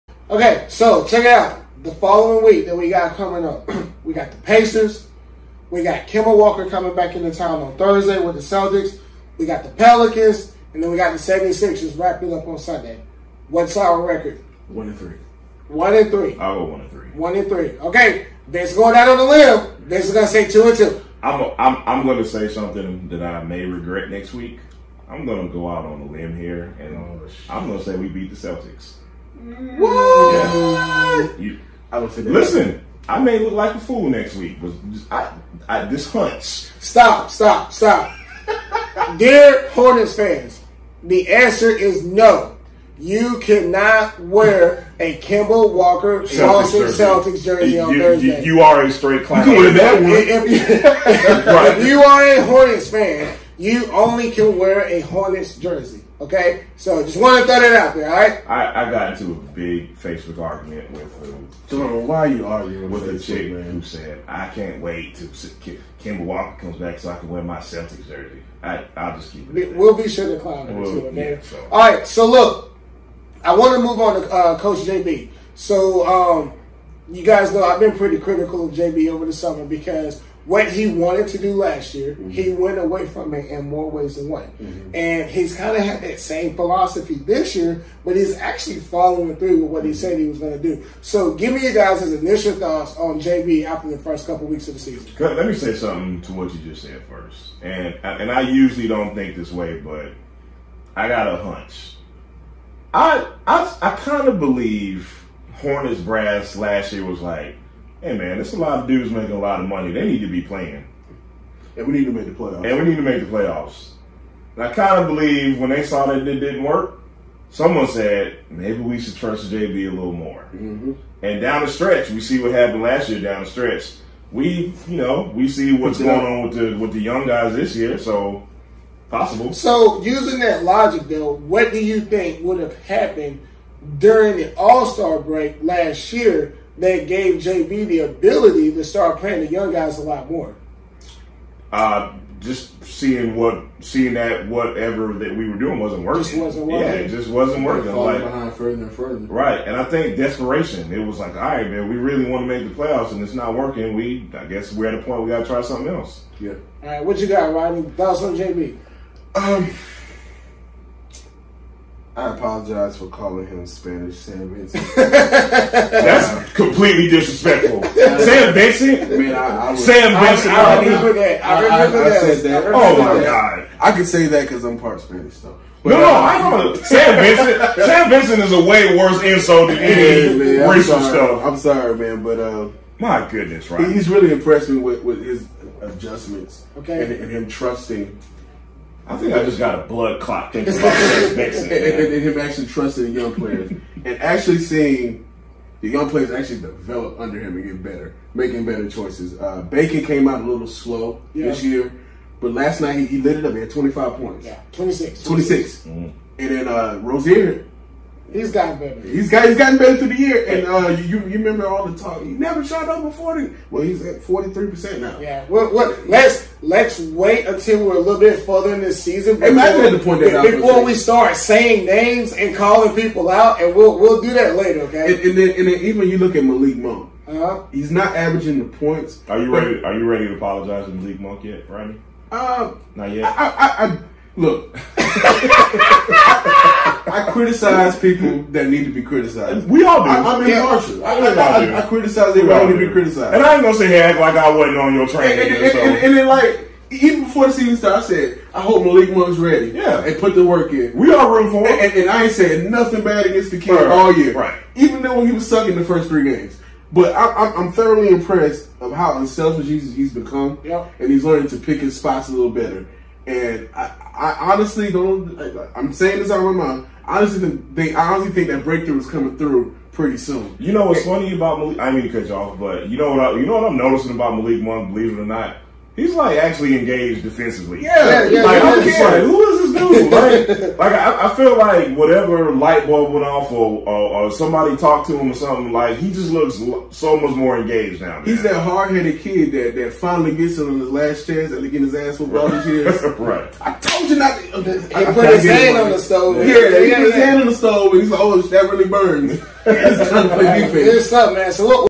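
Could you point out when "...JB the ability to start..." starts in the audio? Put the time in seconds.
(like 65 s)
137 s.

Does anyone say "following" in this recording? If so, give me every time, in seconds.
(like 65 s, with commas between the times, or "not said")
1 s, 88 s.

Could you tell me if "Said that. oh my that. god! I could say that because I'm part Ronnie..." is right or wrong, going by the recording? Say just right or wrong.
wrong.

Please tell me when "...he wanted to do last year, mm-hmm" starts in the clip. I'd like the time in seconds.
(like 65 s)
80 s.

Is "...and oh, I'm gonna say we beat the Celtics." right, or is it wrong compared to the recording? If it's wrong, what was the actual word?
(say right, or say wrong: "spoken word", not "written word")
right.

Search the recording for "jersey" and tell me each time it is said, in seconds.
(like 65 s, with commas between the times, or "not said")
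47 s, 55 s, 68 s.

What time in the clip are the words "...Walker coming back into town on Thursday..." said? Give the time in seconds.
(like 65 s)
6 s.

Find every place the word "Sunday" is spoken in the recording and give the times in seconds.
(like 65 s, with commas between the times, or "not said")
12 s.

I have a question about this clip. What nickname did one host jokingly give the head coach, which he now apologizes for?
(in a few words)
Spanish Sam Vincent.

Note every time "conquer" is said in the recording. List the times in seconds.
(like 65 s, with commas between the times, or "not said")
not said.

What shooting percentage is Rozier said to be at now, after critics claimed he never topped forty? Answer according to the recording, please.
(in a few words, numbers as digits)
43%.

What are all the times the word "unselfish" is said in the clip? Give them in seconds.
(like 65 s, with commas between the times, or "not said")
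259 s.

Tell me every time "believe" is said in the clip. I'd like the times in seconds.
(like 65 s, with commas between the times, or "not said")
104 s, 115 s, 274 s.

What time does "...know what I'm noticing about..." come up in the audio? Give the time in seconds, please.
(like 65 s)
273 s.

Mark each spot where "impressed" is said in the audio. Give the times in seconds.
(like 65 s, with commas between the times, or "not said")
184 s, 258 s.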